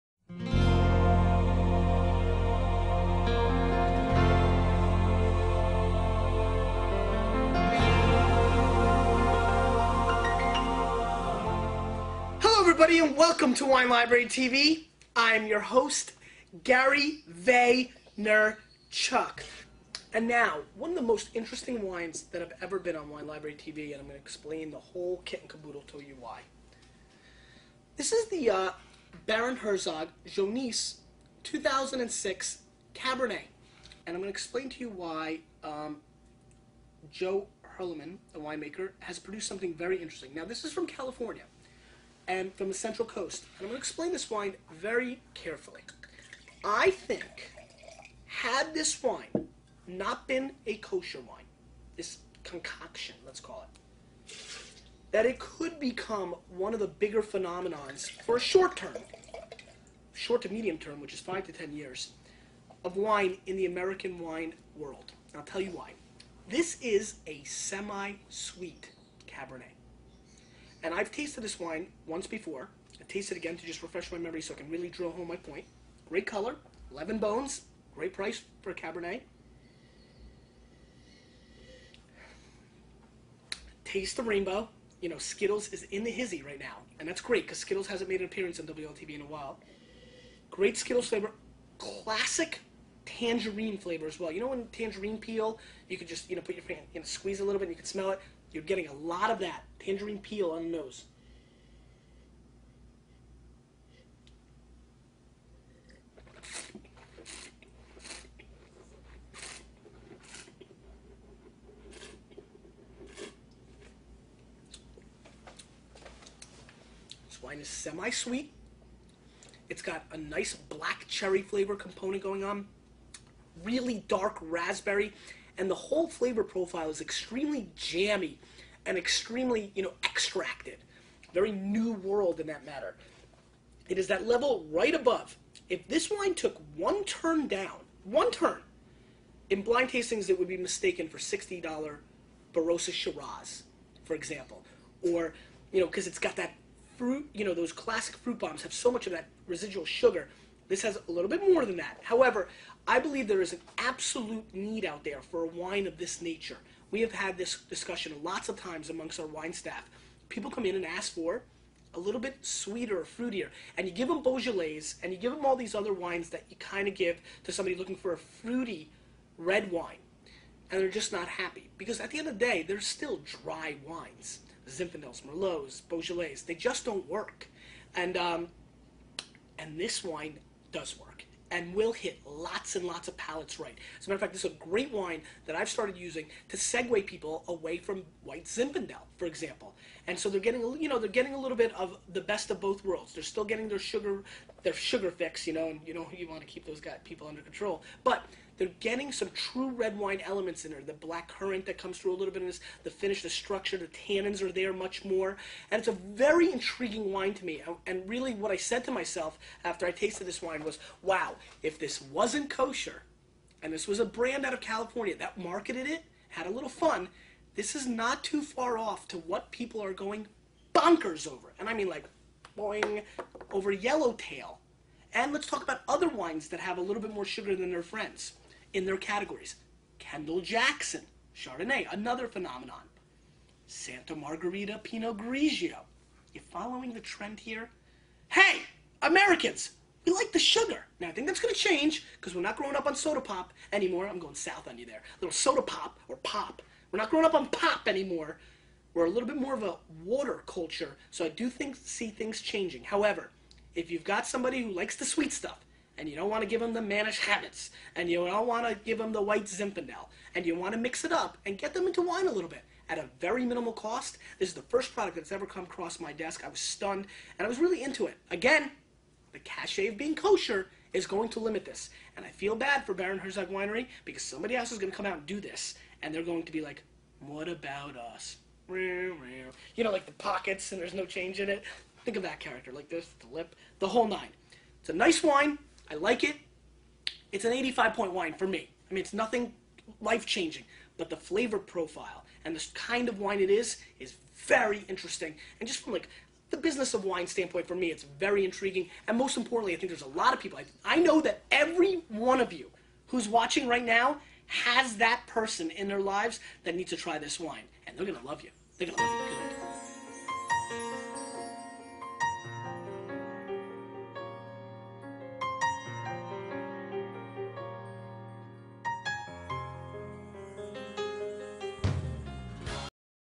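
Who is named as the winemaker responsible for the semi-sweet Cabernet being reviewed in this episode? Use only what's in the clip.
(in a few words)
Joe Hurliman.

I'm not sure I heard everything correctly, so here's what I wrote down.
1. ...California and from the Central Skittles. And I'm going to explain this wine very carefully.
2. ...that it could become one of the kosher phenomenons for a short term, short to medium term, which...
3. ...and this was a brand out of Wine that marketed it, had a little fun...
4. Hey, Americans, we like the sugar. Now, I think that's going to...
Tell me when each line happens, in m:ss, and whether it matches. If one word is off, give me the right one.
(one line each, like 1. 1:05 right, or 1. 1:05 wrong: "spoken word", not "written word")
1. 0:40 wrong: "Coast", not "Skittles"
2. 0:55 wrong: "bigger", not "kosher"
3. 3:33 wrong: "California", not "Wine"
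4. 3:58 right.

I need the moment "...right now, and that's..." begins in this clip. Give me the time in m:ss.
1:26.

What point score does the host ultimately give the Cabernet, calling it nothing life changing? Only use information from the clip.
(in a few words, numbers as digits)
85.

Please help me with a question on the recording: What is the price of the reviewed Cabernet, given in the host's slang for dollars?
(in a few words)
$11.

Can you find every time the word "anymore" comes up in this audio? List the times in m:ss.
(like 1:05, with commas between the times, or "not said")
4:03, 4:07.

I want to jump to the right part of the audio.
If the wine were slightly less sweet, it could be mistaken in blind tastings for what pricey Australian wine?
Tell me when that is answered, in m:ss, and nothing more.
2:21.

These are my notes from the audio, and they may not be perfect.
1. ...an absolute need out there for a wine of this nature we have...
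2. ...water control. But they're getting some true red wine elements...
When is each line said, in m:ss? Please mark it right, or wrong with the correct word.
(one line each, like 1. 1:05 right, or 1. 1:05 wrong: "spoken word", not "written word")
1. 2:33 right
2. 3:17 wrong: "under", not "water".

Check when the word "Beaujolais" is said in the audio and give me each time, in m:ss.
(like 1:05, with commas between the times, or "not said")
2:44, 2:55.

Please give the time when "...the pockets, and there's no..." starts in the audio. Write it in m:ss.
4:40.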